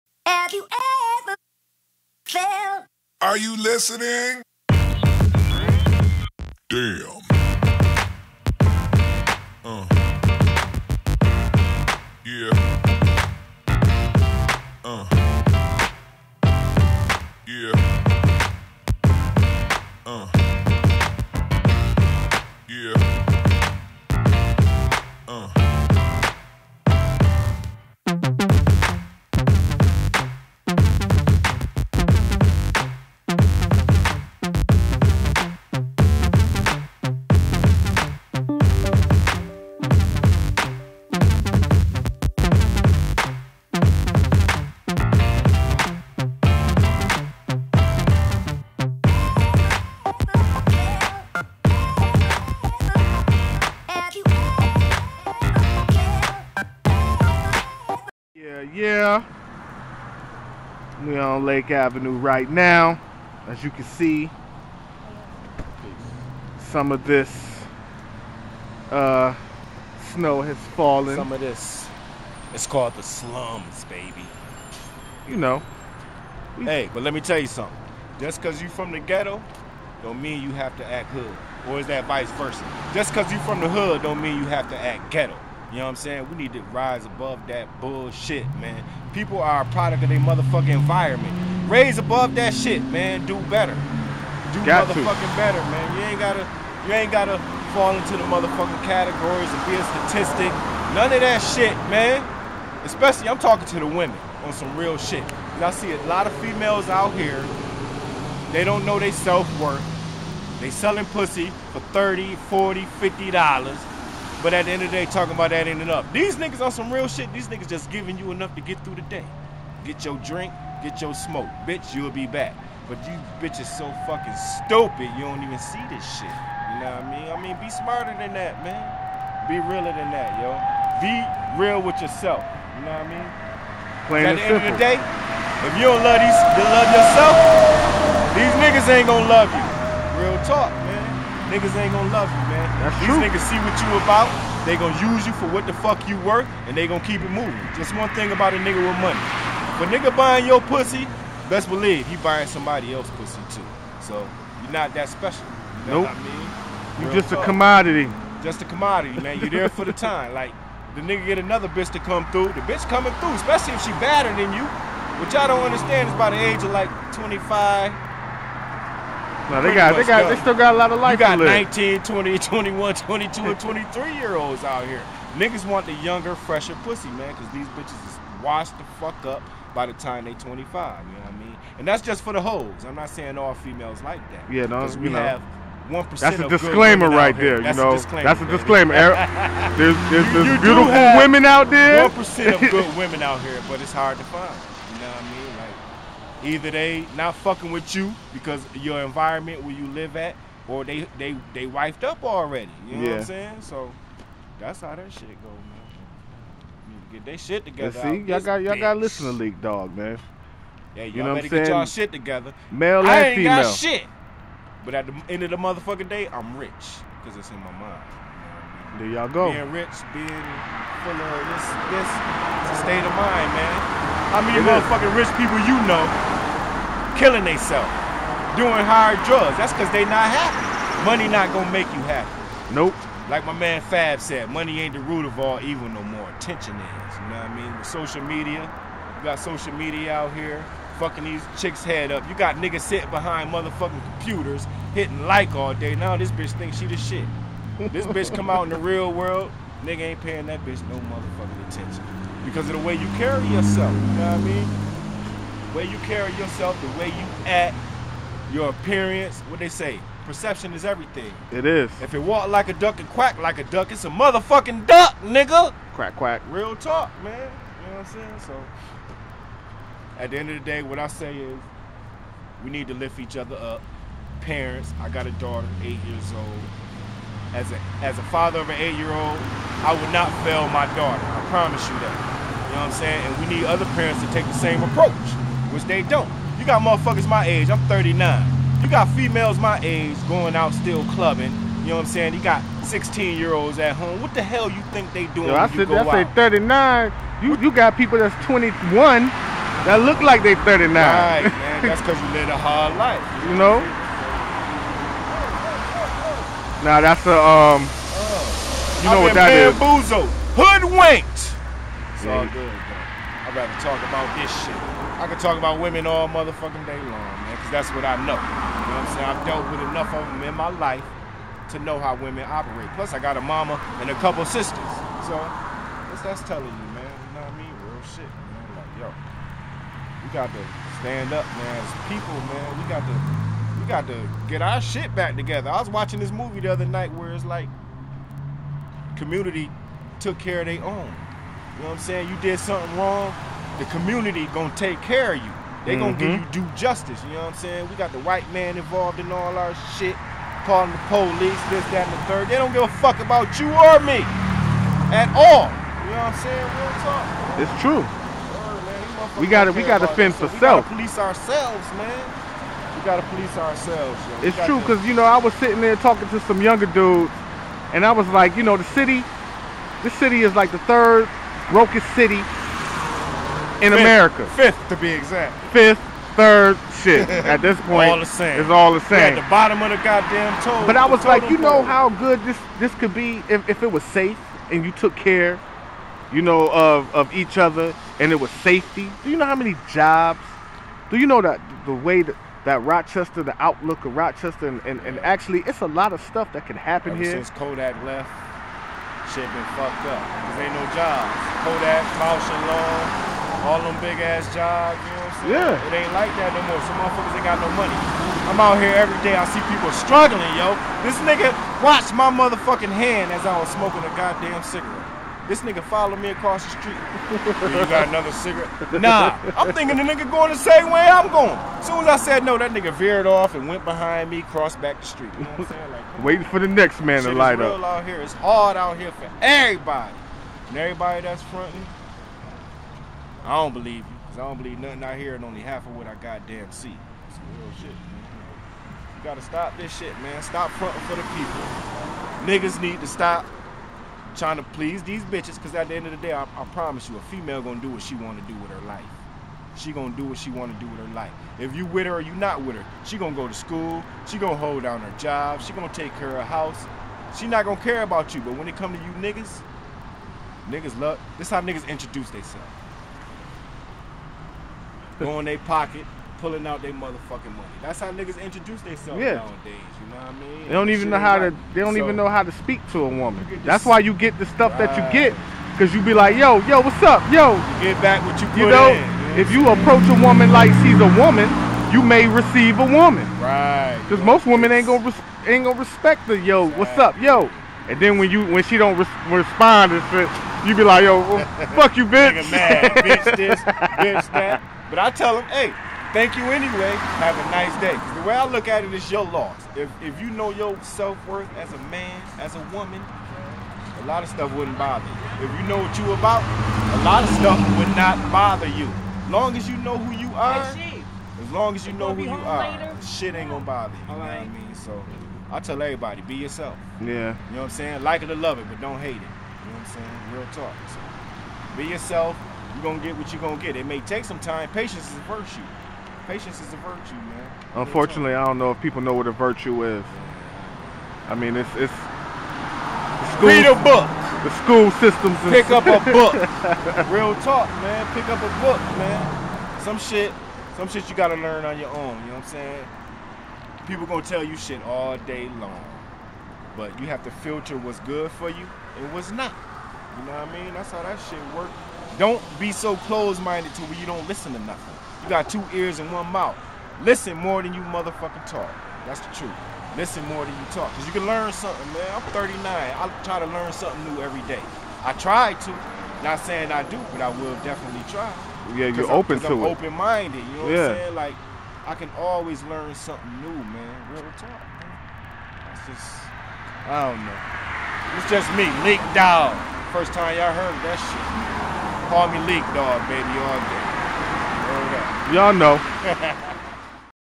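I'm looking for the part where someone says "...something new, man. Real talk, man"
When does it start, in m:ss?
9:32.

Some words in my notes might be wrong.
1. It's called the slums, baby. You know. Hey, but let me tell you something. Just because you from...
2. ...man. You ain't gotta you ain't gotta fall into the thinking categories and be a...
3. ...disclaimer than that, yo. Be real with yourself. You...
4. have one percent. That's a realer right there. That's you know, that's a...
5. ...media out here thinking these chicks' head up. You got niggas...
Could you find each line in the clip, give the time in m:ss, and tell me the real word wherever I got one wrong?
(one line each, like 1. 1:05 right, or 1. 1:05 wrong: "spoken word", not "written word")
1. 1:12 right
2. 1:35 wrong: "motherfucking", not "thinking"
3. 2:09 wrong: "realer", not "disclaimer"
4. 3:05 wrong: "disclaimer", not "realer"
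5. 3:59 wrong: "fucking", not "thinking".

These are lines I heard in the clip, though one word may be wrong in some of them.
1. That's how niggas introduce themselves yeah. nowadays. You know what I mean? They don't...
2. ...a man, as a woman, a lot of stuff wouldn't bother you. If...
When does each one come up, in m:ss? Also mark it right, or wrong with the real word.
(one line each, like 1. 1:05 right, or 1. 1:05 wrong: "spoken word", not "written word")
1. 7:47 right
2. 8:21 right.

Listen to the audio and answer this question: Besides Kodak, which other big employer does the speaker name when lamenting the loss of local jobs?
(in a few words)
Bausch and Lomb.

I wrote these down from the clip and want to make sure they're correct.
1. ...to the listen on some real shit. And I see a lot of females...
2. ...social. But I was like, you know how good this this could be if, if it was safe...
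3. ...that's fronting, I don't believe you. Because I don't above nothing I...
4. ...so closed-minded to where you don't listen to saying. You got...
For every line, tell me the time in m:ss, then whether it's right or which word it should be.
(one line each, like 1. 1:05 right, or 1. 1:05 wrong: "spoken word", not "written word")
1. 1:43 wrong: "women", not "listen"
2. 6:20 wrong: "total", not "social"
3. 7:11 wrong: "believe", not "above"
4. 9:12 wrong: "nothing", not "saying".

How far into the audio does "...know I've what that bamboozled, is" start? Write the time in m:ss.
5:09.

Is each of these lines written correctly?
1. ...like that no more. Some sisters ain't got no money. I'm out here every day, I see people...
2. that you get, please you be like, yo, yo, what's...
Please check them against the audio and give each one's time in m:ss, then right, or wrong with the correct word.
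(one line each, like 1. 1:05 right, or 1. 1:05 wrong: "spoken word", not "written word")
1. 6:46 wrong: "motherfuckers", not "sisters"
2. 7:54 wrong: "cause", not "please".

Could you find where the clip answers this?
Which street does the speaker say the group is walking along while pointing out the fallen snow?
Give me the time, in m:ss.
1:01.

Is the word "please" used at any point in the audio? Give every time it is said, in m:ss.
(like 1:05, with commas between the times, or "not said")
7:24.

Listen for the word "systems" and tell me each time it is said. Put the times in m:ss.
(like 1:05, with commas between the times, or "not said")
8:55.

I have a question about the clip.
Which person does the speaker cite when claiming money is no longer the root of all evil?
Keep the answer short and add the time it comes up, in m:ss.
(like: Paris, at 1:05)
Fab, at 3:53.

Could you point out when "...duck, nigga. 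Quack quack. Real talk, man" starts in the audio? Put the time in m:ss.
4:24.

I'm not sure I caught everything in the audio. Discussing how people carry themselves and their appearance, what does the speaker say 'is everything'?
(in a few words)
Perception.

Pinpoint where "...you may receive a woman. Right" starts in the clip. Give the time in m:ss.
8:01.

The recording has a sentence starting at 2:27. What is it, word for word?
Just one thing about a nigga with money.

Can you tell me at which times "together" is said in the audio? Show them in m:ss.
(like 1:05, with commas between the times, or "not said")
3:27, 3:32, 5:35.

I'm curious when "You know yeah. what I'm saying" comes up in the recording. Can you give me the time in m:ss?
3:22.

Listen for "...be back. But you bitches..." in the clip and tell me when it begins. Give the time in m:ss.
2:02.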